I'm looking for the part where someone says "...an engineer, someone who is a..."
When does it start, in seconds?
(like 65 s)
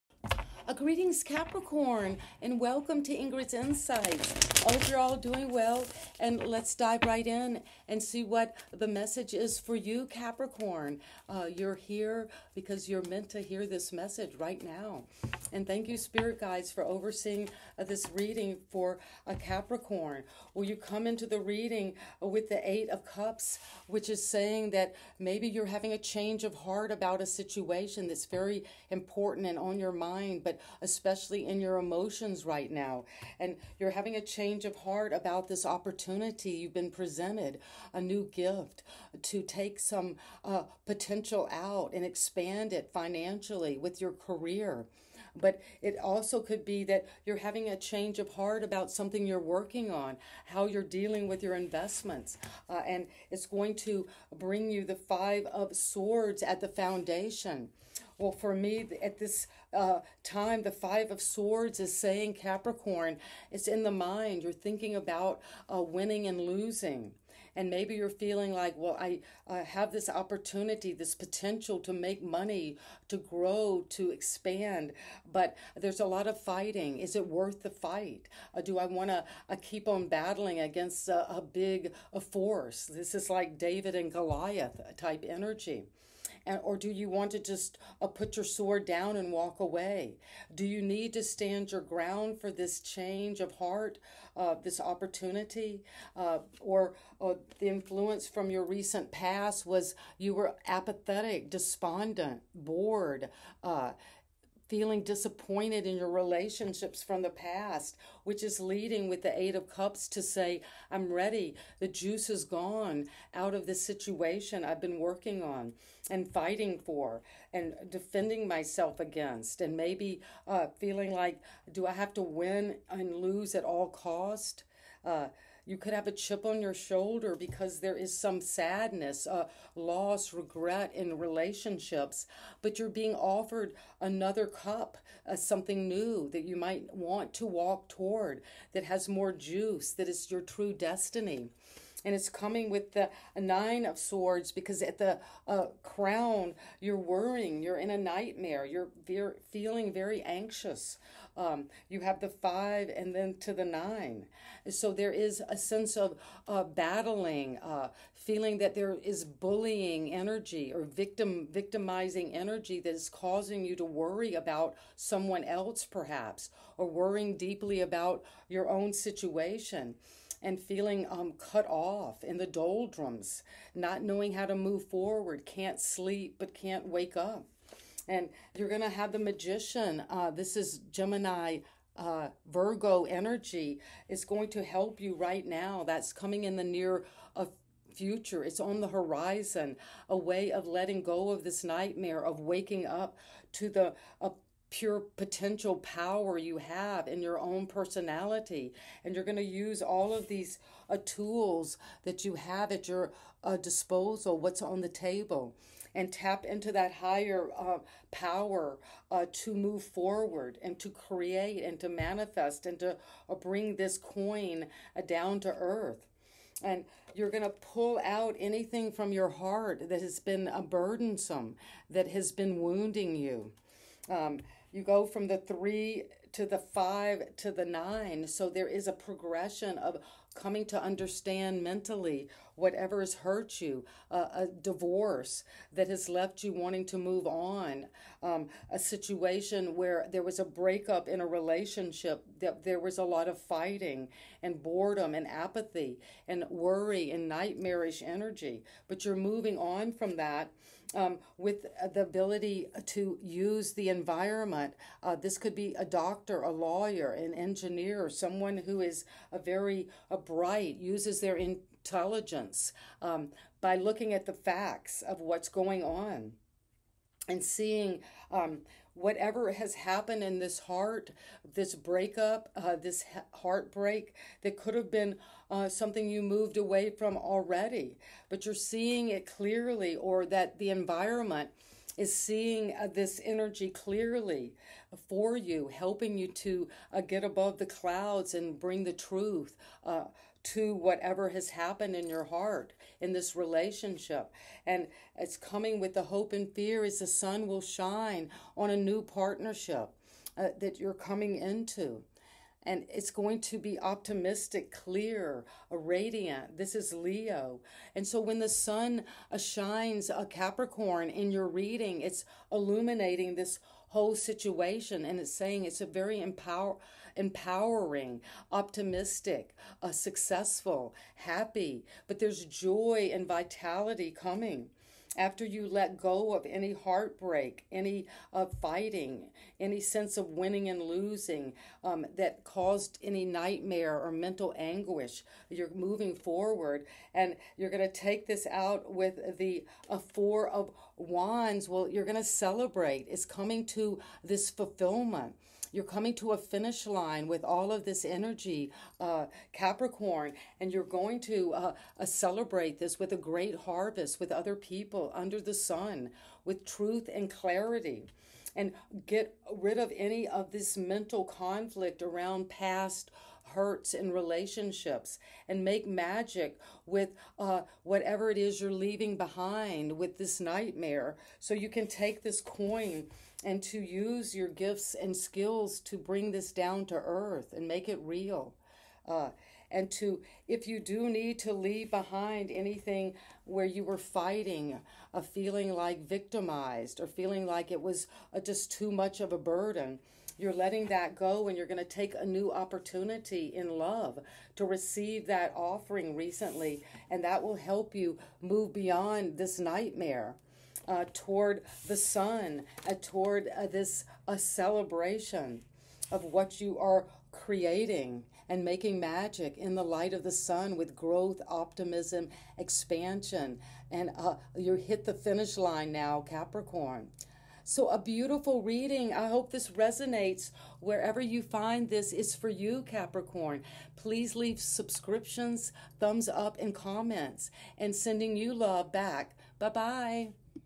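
257 s.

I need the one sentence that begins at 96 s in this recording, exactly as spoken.
Uh, or, or uh, the influence from your recent past was you were apathetic, despondent, bored.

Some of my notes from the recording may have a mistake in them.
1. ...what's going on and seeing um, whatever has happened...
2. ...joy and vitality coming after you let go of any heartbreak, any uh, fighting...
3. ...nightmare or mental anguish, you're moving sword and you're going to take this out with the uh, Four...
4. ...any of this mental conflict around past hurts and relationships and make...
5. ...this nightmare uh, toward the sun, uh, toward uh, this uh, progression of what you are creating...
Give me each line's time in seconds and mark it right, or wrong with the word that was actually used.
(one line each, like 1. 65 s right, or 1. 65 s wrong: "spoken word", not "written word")
1. 265 s right
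2. 322 s right
3. 333 s wrong: "forward", not "sword"
4. 359 s right
5. 399 s wrong: "celebration", not "progression".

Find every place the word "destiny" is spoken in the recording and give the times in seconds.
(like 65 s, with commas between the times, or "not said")
140 s.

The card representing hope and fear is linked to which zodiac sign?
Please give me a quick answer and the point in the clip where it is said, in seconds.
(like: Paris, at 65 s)
Leo, at 306 s.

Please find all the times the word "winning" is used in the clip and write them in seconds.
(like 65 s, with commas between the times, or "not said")
65 s, 330 s.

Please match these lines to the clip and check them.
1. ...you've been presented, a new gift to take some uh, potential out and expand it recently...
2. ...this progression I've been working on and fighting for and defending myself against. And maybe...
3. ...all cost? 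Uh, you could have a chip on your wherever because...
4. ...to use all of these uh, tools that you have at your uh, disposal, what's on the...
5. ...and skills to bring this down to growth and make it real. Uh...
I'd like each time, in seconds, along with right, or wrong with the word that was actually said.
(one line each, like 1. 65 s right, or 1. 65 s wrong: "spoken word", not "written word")
1. 36 s wrong: "financially", not "recently"
2. 113 s wrong: "situation", not "progression"
3. 123 s wrong: "shoulder", not "wherever"
4. 199 s right
5. 374 s wrong: "earth", not "growth".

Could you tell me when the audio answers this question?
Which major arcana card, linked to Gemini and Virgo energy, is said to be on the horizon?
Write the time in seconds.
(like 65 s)
179 s.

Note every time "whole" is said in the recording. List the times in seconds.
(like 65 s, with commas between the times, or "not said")
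313 s.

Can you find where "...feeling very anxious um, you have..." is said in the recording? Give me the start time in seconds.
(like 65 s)
149 s.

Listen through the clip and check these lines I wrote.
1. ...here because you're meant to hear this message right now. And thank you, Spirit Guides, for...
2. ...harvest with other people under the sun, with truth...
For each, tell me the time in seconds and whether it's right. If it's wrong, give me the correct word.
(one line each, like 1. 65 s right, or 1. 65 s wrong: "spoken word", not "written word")
1. 11 s right
2. 353 s right.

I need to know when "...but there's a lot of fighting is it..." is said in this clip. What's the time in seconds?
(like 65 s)
75 s.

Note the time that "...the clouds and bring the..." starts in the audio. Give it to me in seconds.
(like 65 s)
287 s.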